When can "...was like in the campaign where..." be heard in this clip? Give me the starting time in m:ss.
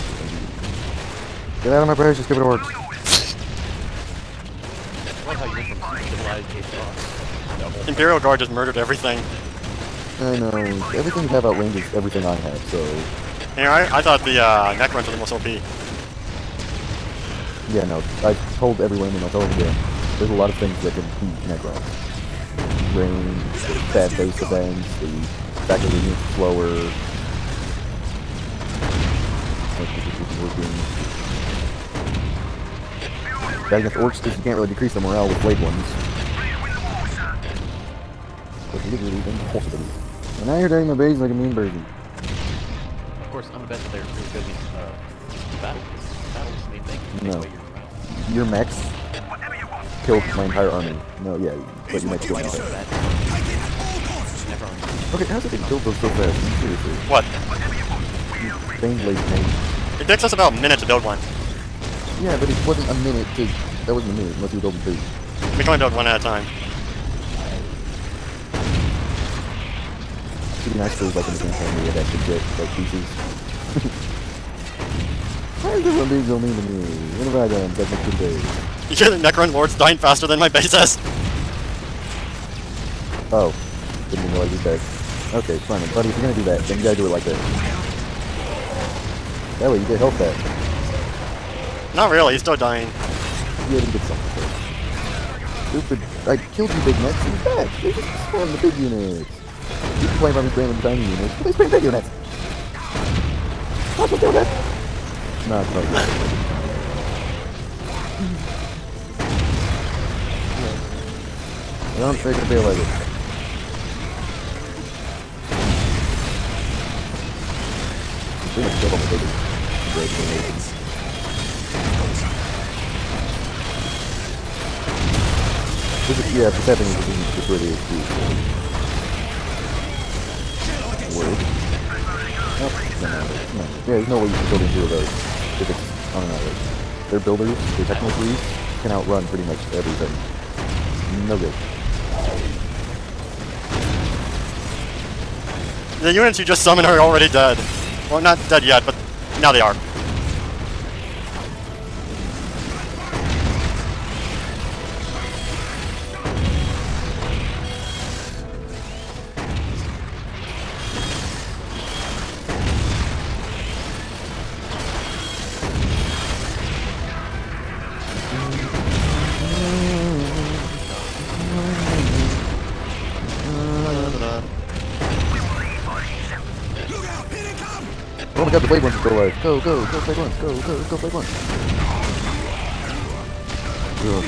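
1:11.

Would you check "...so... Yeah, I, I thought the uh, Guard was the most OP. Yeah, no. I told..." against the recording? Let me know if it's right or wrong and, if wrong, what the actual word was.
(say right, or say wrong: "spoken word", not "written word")
wrong: "Necrunch", not "Guard".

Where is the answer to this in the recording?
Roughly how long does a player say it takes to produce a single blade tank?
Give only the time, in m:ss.
1:00.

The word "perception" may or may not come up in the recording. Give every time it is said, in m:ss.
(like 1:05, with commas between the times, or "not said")
not said.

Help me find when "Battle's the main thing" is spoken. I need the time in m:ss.
0:46.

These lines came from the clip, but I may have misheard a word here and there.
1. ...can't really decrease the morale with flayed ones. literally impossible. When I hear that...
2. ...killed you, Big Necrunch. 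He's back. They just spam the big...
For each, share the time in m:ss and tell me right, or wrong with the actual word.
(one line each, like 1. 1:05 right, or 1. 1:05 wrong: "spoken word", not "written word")
1. 0:34 right
2. 1:36 wrong: "Mac", not "Necrunch".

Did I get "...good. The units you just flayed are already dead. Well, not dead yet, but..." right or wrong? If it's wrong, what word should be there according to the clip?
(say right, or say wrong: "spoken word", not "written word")
wrong: "summoned", not "flayed".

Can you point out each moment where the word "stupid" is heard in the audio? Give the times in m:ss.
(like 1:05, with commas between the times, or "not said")
0:02, 1:35.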